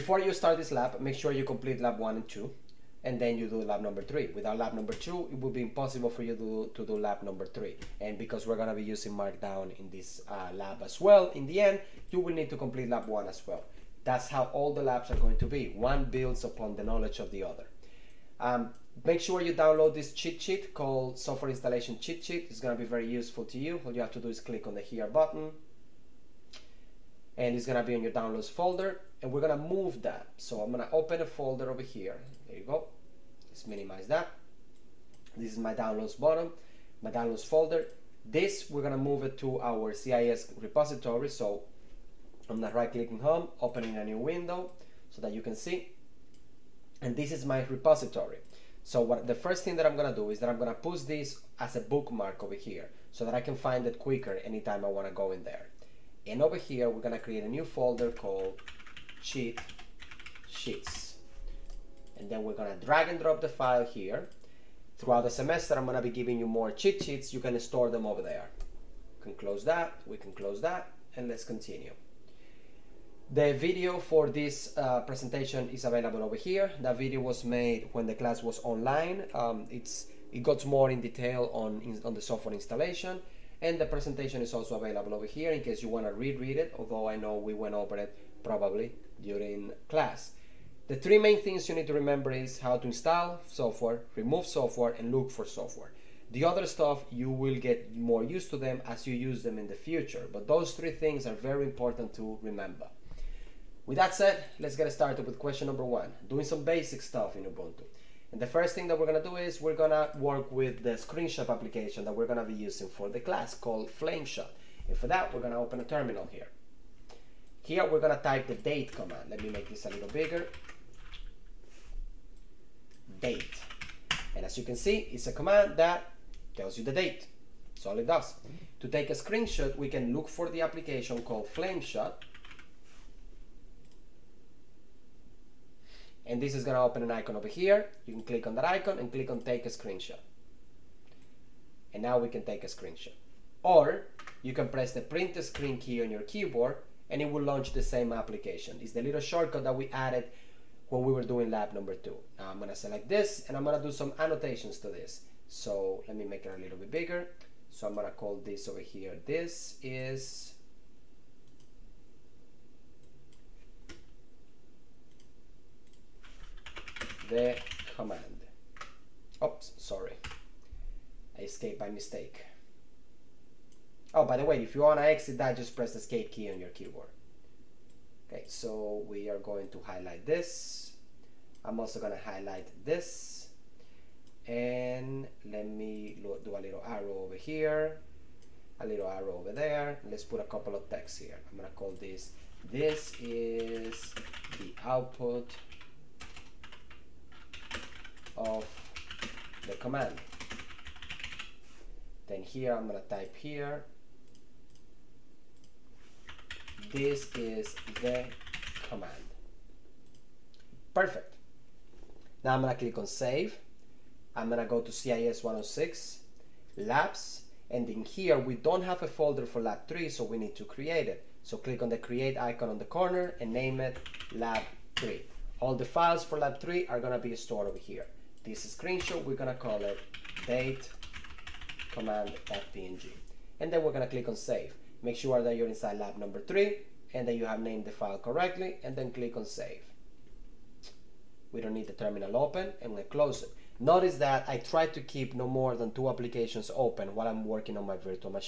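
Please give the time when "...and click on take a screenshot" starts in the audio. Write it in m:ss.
2:18.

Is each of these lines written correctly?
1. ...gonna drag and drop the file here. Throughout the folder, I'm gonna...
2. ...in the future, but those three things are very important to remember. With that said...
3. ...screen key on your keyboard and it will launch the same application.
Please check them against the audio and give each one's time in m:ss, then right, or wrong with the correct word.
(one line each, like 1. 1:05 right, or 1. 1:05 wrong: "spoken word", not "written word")
1. 1:02 wrong: "semester", not "folder"
2. 1:39 right
3. 2:25 right.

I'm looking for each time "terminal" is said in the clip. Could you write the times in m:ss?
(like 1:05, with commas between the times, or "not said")
1:55, 4:01.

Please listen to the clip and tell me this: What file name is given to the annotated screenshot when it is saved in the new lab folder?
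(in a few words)
date command.png.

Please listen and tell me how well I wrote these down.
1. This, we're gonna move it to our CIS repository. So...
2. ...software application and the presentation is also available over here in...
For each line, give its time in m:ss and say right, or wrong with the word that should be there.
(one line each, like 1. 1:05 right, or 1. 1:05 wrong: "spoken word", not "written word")
1. 0:38 right
2. 1:22 wrong: "installation", not "application".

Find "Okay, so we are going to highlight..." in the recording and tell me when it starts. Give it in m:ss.
2:58.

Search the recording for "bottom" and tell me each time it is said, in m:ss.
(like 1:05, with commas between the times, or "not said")
0:36.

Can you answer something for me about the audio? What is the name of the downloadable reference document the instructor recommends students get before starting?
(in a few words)
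Software Installation Cheat Sheet.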